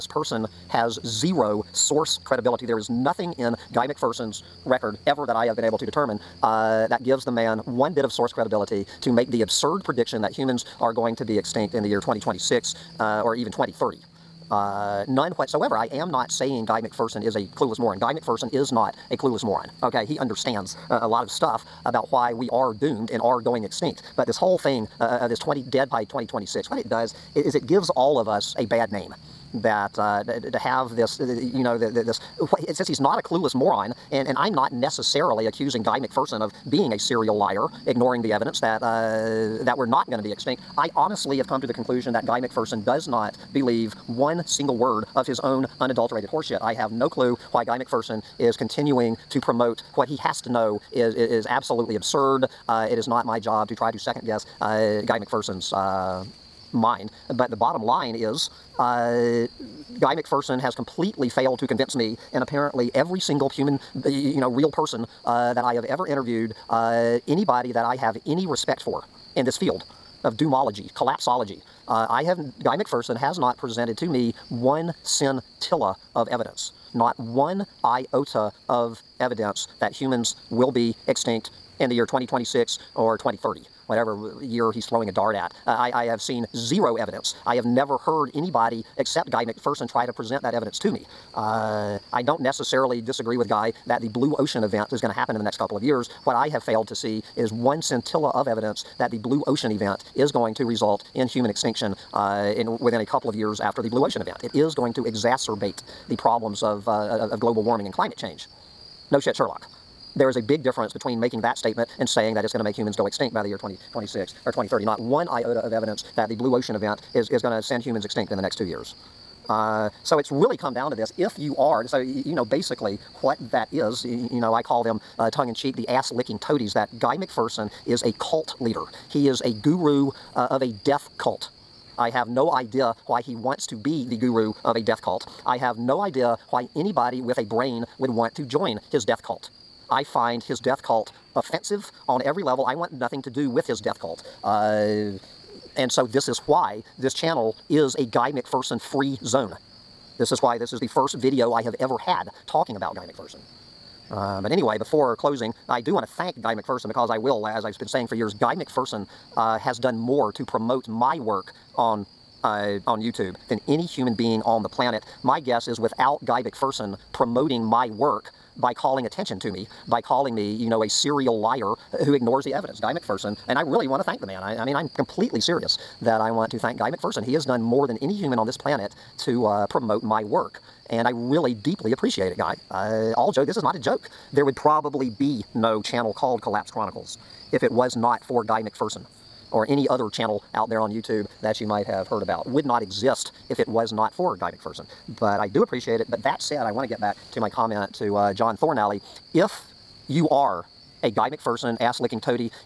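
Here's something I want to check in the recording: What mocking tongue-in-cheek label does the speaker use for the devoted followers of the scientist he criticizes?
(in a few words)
ass-licking toadies.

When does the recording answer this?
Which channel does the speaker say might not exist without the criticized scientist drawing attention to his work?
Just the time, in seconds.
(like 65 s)
186 s.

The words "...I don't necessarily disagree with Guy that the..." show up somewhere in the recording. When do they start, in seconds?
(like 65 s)
92 s.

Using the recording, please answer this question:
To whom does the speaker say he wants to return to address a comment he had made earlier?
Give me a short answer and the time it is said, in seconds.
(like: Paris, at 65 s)
John Thornalley, at 198 s.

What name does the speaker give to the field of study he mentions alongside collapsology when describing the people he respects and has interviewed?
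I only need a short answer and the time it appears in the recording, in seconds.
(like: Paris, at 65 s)
doomology, at 70 s.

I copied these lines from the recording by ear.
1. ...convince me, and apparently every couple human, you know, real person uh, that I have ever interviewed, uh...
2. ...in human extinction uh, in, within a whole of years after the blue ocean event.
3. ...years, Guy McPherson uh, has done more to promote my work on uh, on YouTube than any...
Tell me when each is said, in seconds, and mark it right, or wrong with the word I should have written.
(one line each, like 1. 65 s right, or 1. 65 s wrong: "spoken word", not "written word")
1. 61 s wrong: "single", not "couple"
2. 101 s wrong: "couple", not "whole"
3. 158 s right.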